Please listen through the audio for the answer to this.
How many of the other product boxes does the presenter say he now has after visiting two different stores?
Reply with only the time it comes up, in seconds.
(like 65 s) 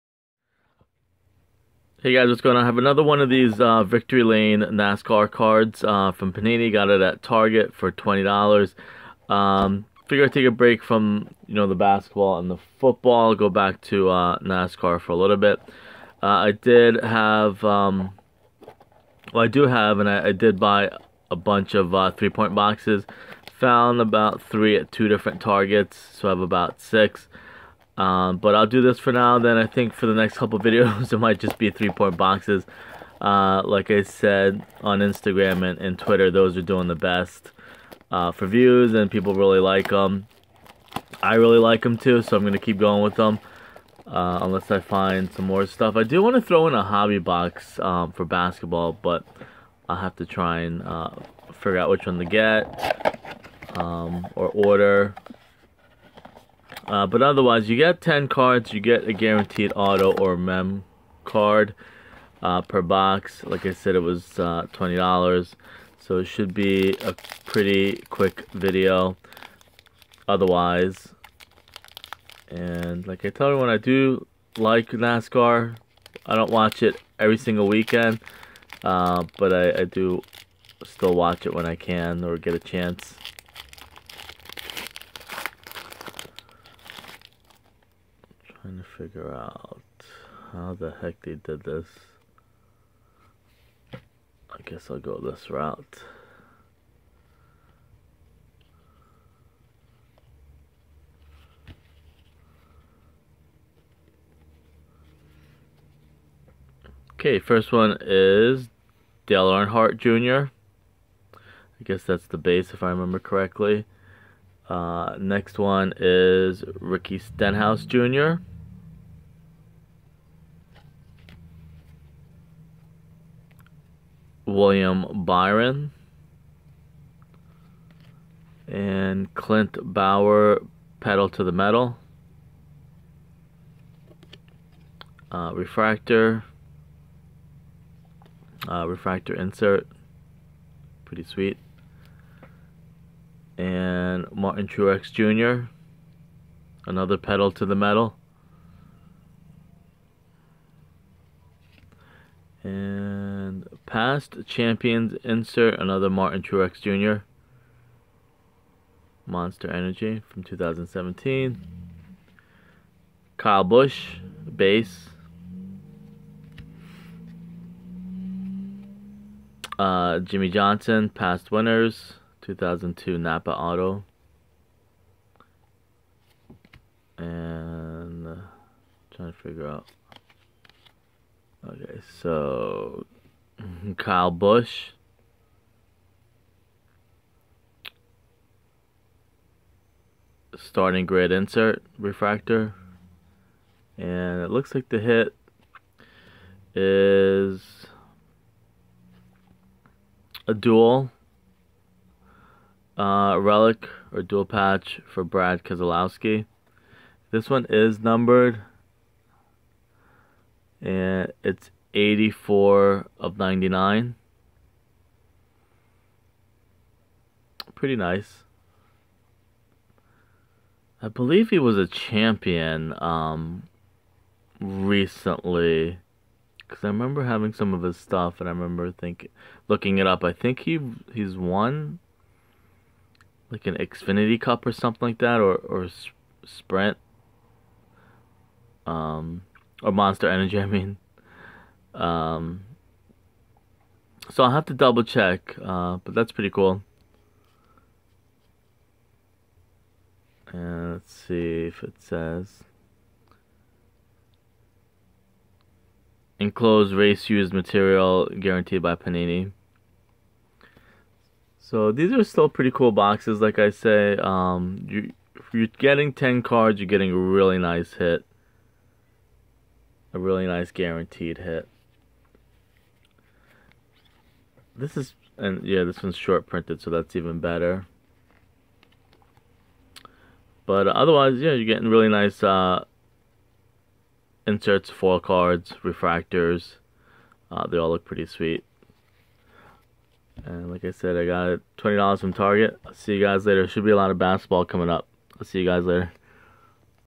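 26 s.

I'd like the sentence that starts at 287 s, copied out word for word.
Uh, they all look pretty sweet.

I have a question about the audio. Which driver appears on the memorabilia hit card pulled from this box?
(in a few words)
Brad Keselowski.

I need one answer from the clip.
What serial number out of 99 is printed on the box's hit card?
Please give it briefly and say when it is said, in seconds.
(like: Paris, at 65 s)
84, at 211 s.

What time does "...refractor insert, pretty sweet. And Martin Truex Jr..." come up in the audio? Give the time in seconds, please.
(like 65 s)
138 s.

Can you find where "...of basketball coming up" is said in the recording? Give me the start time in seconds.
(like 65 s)
294 s.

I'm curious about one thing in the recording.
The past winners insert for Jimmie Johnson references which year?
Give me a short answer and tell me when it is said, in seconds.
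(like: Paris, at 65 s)
2002, at 172 s.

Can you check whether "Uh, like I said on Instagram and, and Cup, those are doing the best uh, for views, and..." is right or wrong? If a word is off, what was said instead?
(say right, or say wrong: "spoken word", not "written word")
wrong: "Twitter", not "Cup".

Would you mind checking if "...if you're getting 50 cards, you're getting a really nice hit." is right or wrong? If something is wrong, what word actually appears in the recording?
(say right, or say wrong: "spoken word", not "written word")
wrong: "10", not "50".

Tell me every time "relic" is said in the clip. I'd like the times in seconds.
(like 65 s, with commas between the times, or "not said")
203 s.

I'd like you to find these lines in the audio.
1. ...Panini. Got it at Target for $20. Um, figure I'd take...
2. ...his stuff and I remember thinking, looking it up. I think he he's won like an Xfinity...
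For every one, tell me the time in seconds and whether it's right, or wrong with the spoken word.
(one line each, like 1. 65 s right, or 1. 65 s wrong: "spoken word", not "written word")
1. 6 s right
2. 227 s right.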